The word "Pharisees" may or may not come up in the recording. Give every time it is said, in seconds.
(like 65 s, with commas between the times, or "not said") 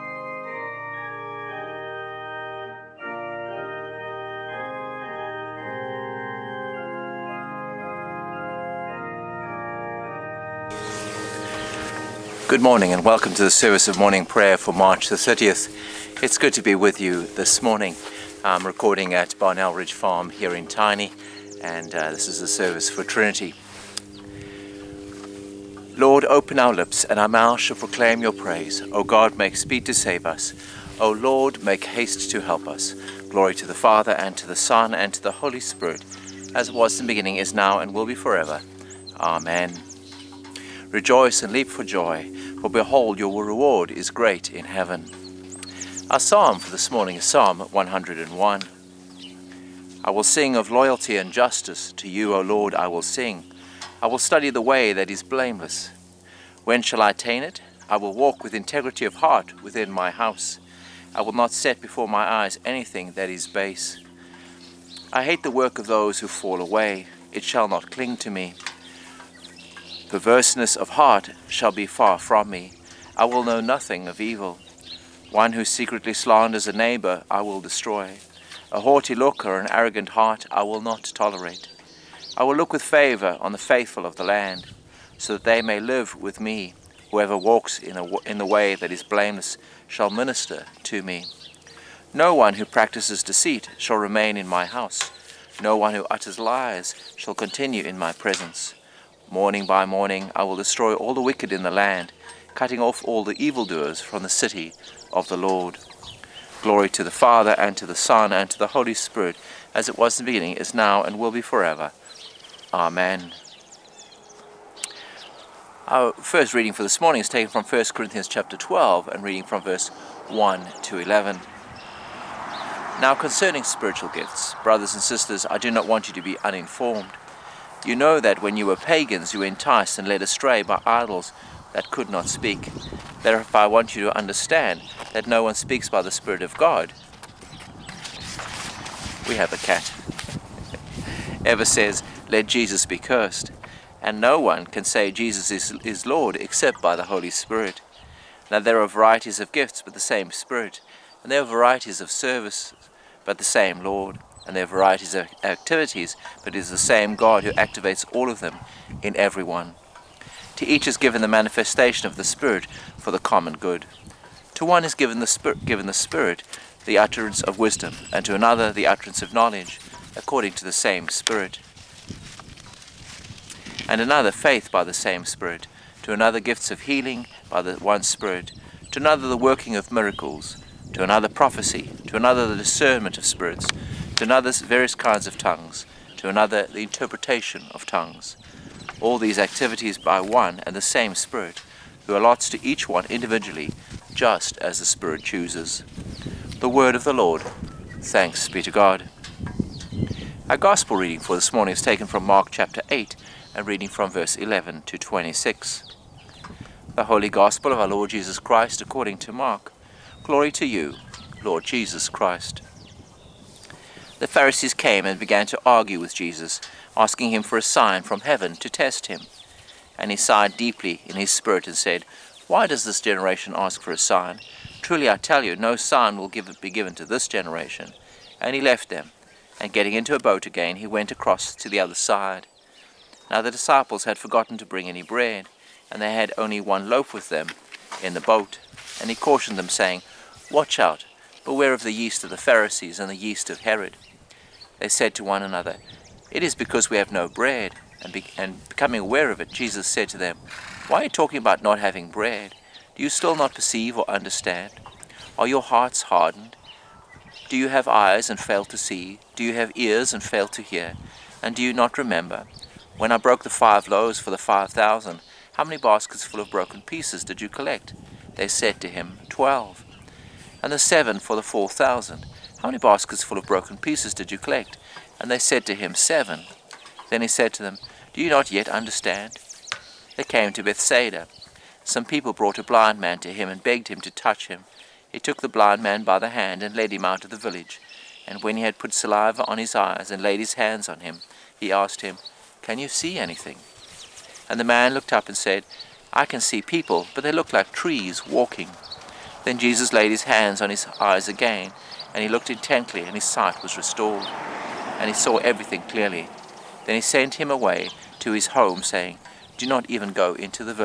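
214 s, 242 s.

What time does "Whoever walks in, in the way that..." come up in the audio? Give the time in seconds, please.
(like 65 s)
87 s.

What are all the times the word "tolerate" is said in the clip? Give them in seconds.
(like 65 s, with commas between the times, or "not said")
81 s.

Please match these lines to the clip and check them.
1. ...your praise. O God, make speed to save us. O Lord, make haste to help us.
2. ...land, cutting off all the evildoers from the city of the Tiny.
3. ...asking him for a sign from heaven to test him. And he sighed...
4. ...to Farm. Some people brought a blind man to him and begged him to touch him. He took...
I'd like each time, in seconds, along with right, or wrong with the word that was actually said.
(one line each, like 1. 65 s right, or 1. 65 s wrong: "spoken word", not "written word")
1. 28 s right
2. 101 s wrong: "Lord", not "Tiny"
3. 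216 s right
4. 280 s wrong: "Bethsaida", not "Farm".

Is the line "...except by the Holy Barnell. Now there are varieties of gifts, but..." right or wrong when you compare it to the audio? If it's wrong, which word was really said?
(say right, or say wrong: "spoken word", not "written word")
wrong: "Spirit", not "Barnell".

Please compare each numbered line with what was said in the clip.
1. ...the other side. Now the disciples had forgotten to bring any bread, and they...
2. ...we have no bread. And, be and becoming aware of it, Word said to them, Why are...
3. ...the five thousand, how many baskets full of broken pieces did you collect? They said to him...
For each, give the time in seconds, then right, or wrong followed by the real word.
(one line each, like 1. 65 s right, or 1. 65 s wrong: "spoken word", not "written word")
1. 231 s right
2. 246 s wrong: "Jesus", not "Word"
3. 264 s right.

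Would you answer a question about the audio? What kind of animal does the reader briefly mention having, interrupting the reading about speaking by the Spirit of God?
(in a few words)
A cat.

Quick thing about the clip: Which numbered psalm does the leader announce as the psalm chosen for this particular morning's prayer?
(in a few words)
Psalm 101.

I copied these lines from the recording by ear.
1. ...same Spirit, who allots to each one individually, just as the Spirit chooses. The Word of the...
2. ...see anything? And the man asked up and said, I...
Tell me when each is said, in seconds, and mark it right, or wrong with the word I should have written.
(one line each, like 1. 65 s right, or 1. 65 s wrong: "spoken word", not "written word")
1. 190 s right
2. 292 s wrong: "looked", not "asked".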